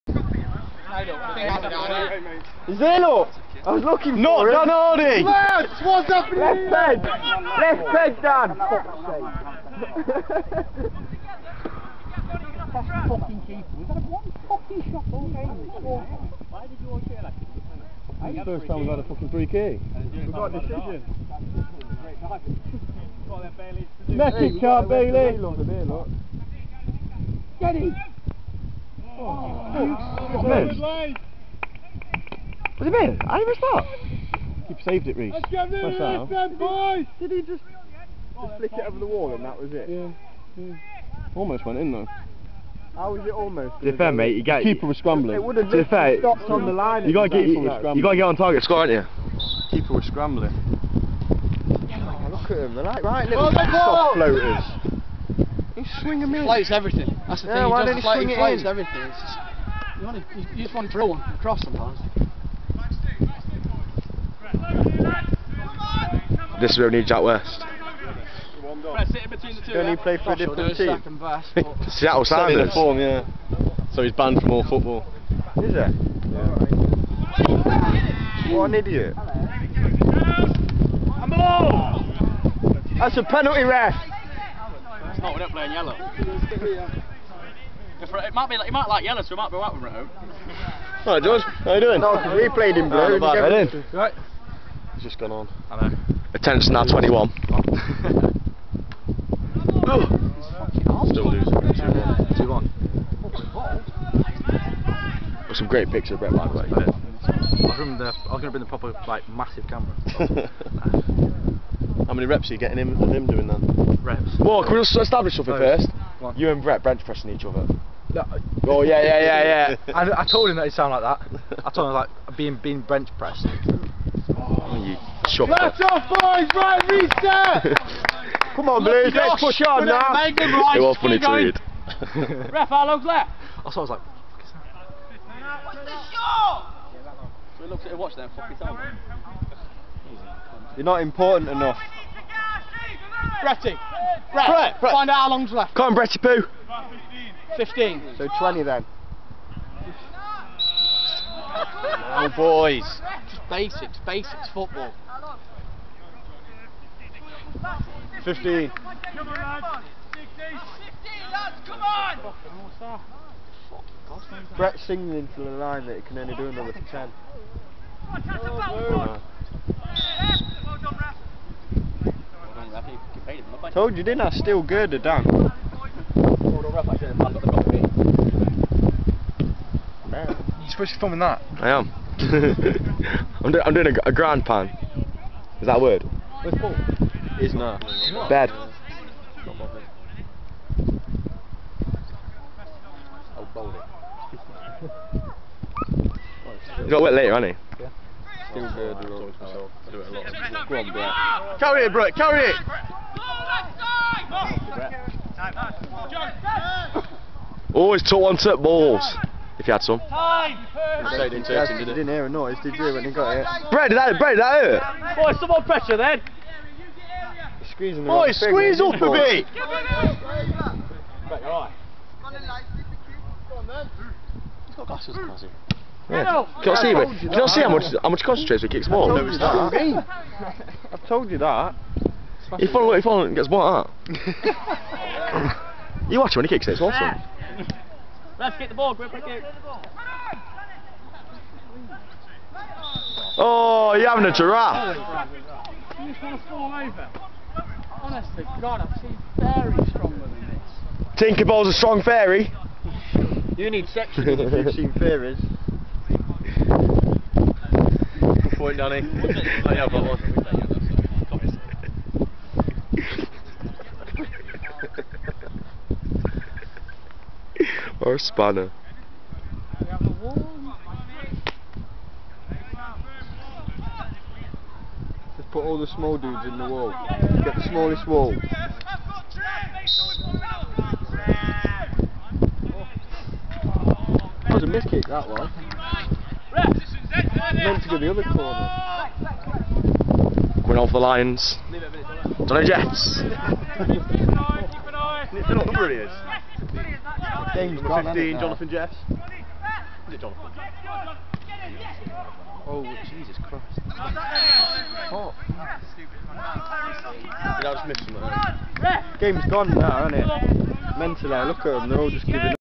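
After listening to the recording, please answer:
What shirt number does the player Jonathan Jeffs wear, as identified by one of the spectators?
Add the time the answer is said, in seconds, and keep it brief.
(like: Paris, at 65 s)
15, at 297 s.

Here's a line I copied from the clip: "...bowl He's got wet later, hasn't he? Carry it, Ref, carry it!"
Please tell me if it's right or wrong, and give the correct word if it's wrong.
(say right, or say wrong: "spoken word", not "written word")
wrong: "Brett", not "Ref".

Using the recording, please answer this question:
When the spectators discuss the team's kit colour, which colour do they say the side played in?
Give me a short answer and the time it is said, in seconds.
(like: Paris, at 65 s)
Blue, at 92 s.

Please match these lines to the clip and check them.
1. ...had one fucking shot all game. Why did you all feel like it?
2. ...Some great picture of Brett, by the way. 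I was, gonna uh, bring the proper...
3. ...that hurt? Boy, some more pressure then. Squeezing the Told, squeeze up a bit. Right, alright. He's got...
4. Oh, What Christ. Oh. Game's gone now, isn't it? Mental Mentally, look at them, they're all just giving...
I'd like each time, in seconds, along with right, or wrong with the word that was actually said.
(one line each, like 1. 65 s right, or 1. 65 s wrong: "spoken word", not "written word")
1. 13 s right
2. 105 s right
3. 214 s wrong: "Boy", not "Told"
4. 302 s wrong: "Jesus", not "What".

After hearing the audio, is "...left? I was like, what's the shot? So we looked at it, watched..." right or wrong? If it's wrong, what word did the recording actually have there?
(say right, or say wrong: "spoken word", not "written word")
right.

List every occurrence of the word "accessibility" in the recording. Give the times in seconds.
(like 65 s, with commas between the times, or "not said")
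not said.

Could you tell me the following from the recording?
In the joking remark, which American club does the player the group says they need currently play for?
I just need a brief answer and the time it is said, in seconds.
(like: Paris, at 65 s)
Seattle Sounders, at 71 s.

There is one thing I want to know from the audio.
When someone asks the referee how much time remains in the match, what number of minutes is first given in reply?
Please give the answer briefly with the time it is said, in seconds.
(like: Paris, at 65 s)
15, at 147 s.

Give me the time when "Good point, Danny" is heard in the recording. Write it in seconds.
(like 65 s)
258 s.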